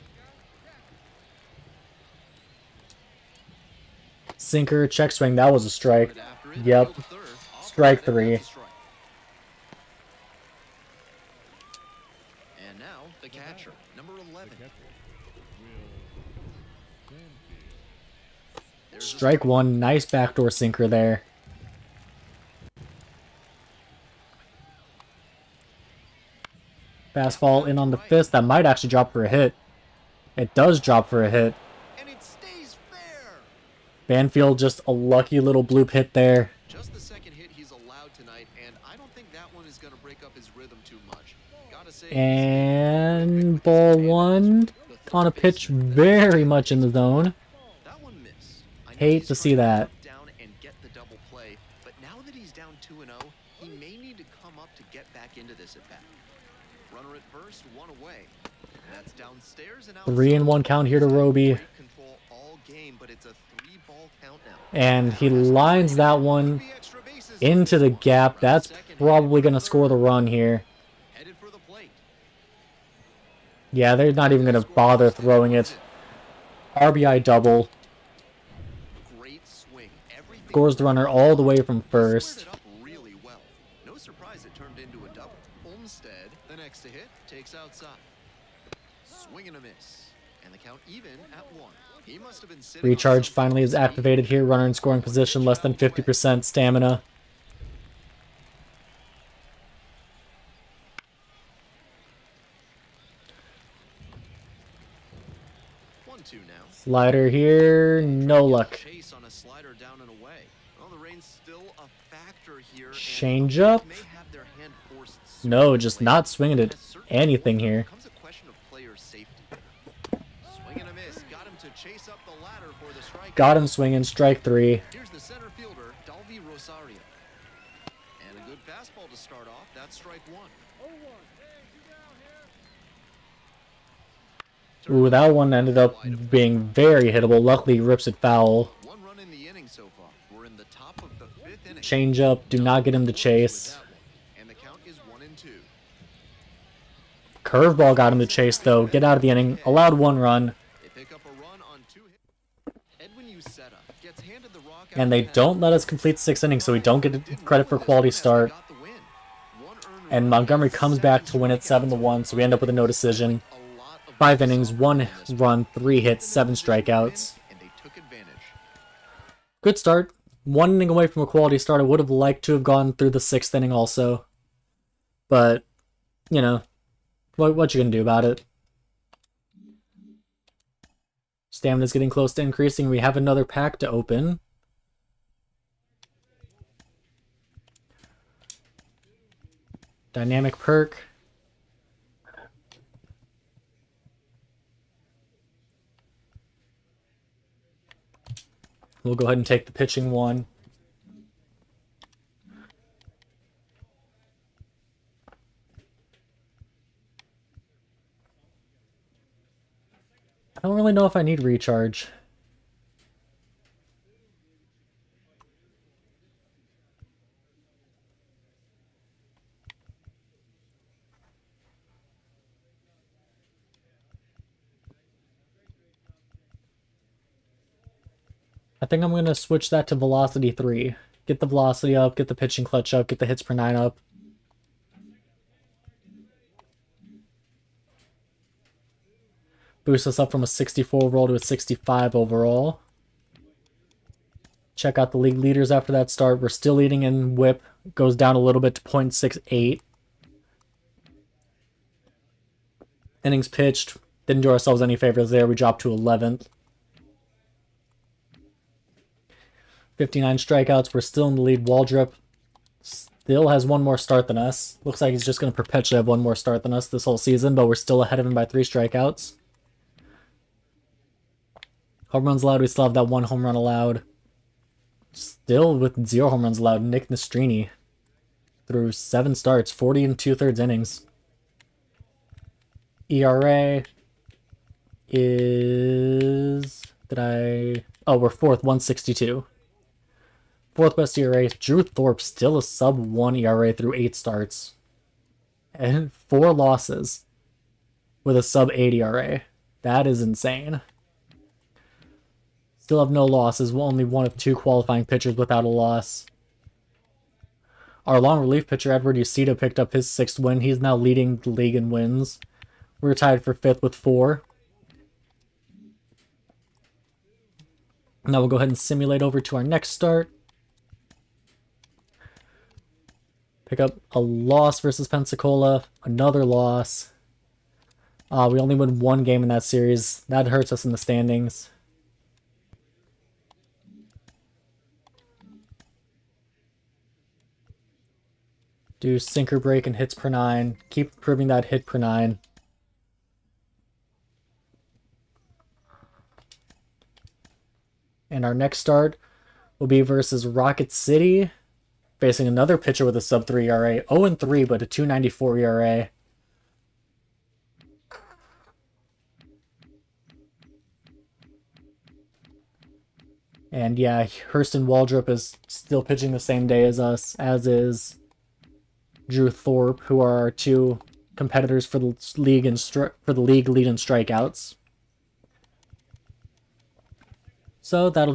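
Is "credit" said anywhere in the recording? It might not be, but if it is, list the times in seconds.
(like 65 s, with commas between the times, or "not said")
157 s.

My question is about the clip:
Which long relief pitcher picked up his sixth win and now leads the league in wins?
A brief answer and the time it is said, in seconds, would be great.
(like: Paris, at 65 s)
Edward Uceda, at 308 s.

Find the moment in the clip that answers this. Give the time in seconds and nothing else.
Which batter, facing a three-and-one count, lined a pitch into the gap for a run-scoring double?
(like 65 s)
61 s.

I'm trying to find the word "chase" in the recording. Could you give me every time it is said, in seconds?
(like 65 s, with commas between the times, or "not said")
121 s, 143 s, 148 s.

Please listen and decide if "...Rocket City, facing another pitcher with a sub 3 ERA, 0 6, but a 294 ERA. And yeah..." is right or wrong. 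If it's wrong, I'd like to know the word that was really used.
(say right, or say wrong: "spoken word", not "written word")
wrong: "3", not "6".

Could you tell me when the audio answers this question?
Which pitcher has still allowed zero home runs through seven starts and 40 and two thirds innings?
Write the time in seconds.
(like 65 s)
276 s.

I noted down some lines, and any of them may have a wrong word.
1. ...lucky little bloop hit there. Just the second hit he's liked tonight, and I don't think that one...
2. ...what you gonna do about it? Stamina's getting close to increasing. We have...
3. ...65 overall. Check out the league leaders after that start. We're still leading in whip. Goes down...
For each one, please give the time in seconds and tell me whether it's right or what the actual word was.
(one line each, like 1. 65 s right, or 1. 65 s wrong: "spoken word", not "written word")
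1. 34 s wrong: "allowed", not "liked"
2. 177 s right
3. 241 s right.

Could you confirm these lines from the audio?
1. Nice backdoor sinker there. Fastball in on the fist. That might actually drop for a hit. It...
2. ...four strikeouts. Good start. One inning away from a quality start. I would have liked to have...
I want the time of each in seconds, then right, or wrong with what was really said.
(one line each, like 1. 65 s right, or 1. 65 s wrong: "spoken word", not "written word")
1. 19 s right
2. 166 s wrong: "seven", not "four".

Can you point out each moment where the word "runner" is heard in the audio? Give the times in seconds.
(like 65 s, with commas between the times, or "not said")
80 s, 94 s.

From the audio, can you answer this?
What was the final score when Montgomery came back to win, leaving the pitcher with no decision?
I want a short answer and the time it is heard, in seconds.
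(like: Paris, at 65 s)
7 to 1, at 161 s.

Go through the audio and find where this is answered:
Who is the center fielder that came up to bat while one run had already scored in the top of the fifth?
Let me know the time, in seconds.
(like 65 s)
126 s.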